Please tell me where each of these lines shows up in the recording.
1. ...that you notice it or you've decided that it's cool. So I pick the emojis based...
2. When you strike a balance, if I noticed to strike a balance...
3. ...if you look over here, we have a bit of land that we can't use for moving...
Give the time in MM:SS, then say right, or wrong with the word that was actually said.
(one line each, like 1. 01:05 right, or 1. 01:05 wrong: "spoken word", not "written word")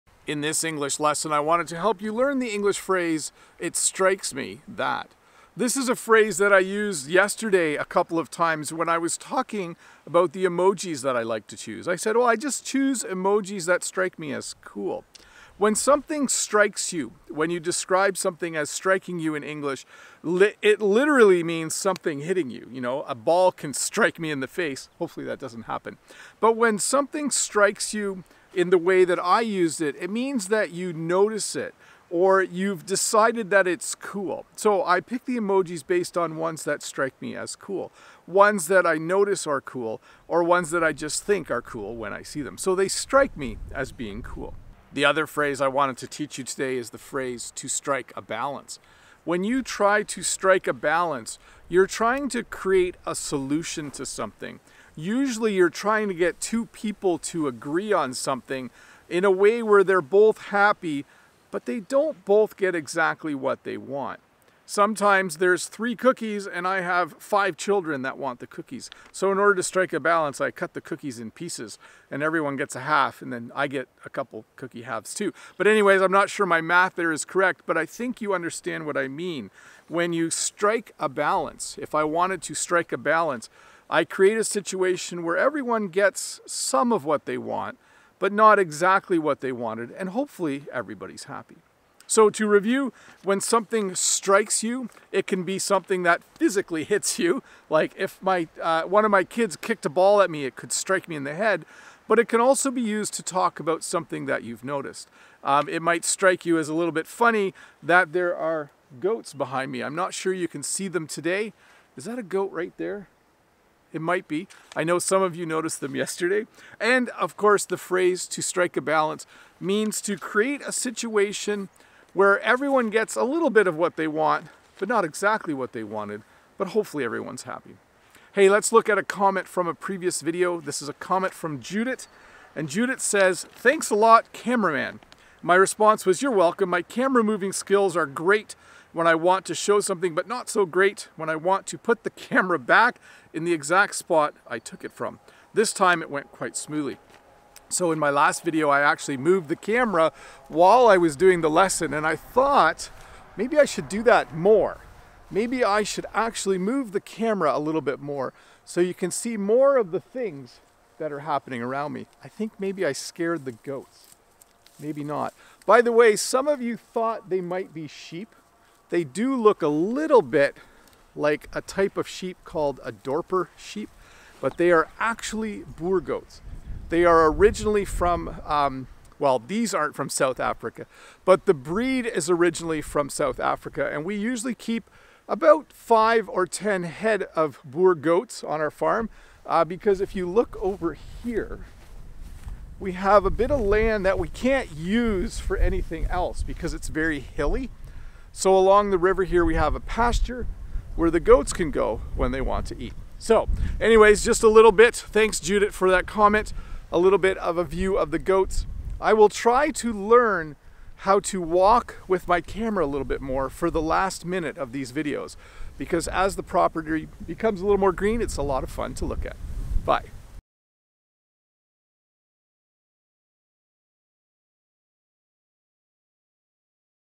1. 00:30 right
2. 01:19 wrong: "wanted", not "noticed"
3. 03:10 wrong: "anything", not "moving".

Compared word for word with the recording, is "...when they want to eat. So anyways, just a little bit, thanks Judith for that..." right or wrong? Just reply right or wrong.
right.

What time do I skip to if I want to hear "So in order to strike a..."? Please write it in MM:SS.
01:09.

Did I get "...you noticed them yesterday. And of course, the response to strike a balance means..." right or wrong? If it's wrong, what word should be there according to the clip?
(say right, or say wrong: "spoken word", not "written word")
wrong: "phrase", not "response".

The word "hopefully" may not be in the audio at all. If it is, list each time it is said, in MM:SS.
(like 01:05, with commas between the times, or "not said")
00:24, 01:30, 02:06.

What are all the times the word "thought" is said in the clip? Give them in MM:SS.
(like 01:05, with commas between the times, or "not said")
02:32, 02:46.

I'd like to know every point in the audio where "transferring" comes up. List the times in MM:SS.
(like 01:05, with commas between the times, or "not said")
not said.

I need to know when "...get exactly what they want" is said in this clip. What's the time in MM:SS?
01:02.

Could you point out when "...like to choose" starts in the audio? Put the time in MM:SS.
00:11.